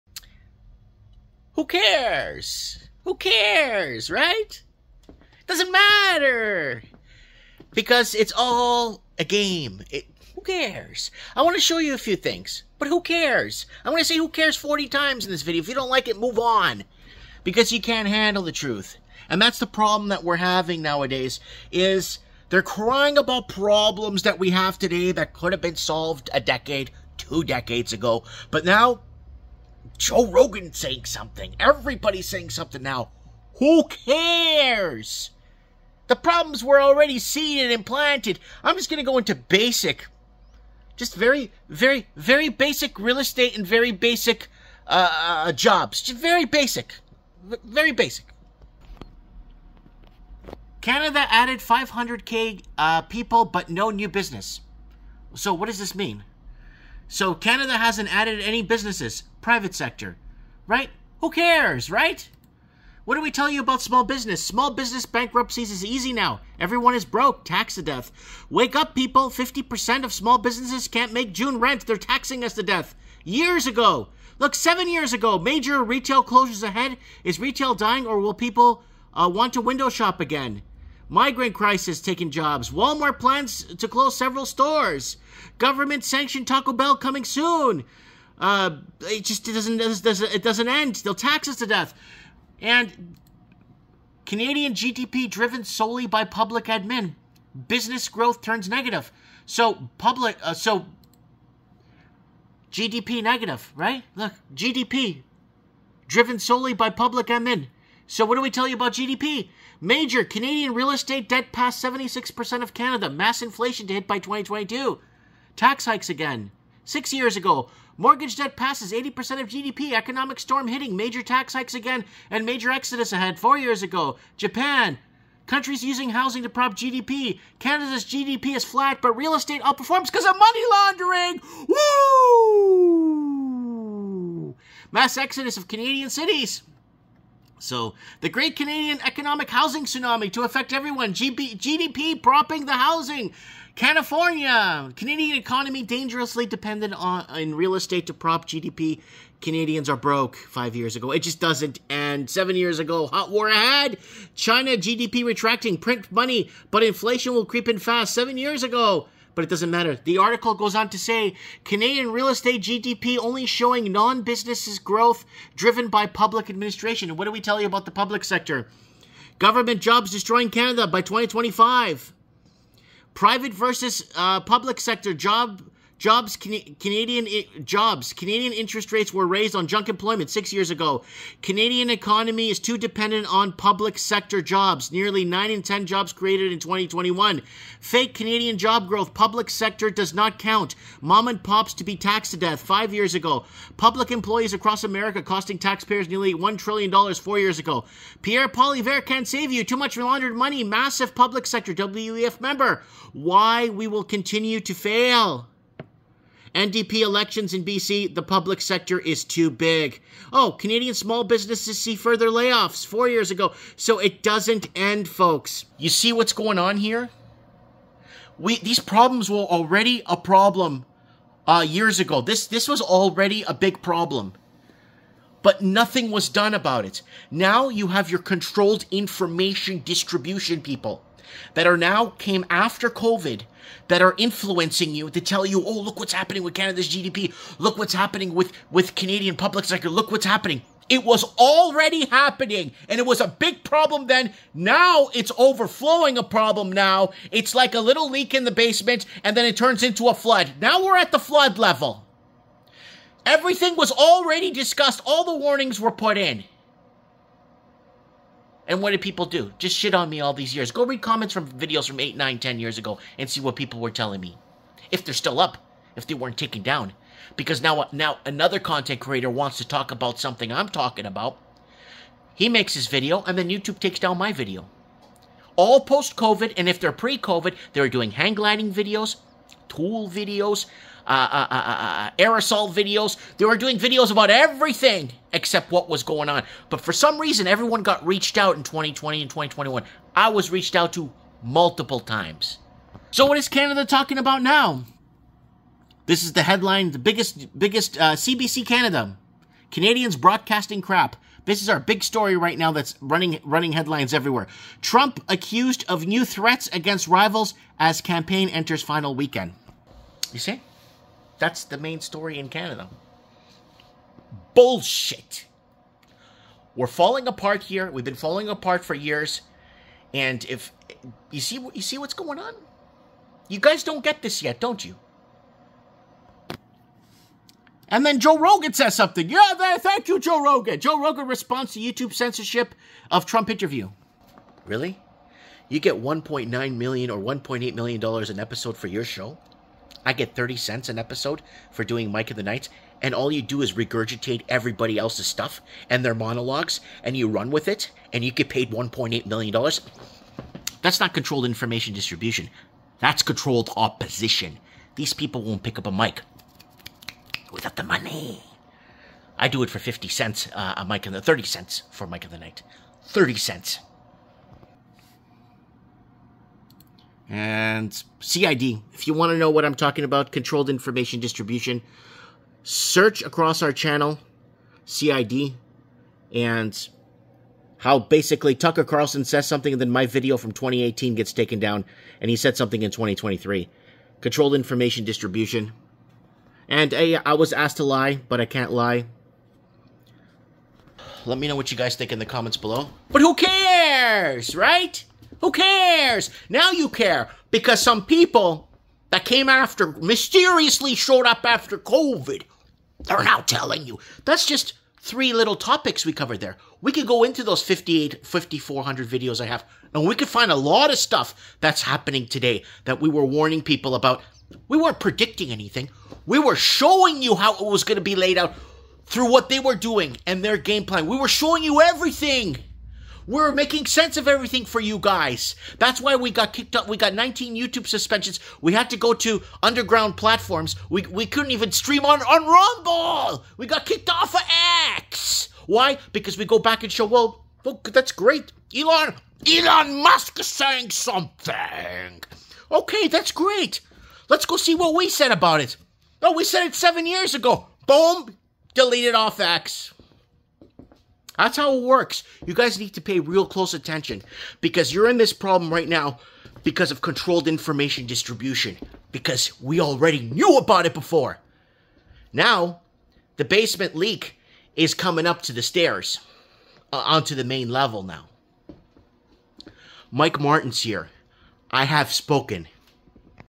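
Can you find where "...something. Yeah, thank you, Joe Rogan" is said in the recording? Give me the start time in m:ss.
5:28.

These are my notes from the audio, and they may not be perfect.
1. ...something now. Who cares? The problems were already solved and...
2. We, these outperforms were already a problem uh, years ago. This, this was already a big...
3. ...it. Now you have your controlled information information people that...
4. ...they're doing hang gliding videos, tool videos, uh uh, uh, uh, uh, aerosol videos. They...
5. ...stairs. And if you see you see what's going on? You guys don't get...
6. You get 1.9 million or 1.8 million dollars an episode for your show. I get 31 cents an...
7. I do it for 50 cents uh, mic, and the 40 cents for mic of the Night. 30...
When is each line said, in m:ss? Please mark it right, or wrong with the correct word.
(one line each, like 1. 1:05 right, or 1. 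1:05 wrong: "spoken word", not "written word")
1. 0:32 wrong: "seeded", not "solved"
2. 3:38 wrong: "problems", not "outperforms"
3. 3:46 wrong: "distribution", not "information"
4. 4:37 right
5. 5:18 wrong: "years", not "stairs"
6. 5:35 wrong: "30", not "31"
7. 5:59 wrong: "30", not "40".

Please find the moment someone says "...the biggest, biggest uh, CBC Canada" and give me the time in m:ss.
4:56.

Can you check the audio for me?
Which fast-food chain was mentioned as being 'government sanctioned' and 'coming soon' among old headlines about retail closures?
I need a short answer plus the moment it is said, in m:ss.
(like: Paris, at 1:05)
Taco Bell, at 1:26.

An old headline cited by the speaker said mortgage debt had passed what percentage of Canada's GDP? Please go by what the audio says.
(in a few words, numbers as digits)
80%.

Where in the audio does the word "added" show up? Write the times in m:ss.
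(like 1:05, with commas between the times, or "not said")
0:51, 0:58.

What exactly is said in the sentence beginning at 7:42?
Now, the basement leak is coming up to the stairs uh, onto the main level now.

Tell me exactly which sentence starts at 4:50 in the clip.
I was reached out to multiple times.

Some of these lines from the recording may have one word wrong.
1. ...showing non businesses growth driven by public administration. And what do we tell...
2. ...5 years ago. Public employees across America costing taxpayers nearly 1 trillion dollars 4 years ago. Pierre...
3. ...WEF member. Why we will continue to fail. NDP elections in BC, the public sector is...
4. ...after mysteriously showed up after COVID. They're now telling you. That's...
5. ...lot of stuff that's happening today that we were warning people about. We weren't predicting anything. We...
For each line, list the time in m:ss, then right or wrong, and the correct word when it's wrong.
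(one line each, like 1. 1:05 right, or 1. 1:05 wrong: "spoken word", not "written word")
1. 2:43 right
2. 3:12 right
3. 3:21 right
4. 6:39 right
5. 6:50 right.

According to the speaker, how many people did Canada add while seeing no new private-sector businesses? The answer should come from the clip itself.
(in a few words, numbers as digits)
500k.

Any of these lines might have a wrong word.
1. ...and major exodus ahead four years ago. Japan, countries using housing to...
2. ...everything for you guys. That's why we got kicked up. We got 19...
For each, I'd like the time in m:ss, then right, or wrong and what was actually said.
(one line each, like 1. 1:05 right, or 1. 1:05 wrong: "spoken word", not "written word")
1. 2:02 right
2. 7:04 right.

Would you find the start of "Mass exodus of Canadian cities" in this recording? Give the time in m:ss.
2:14.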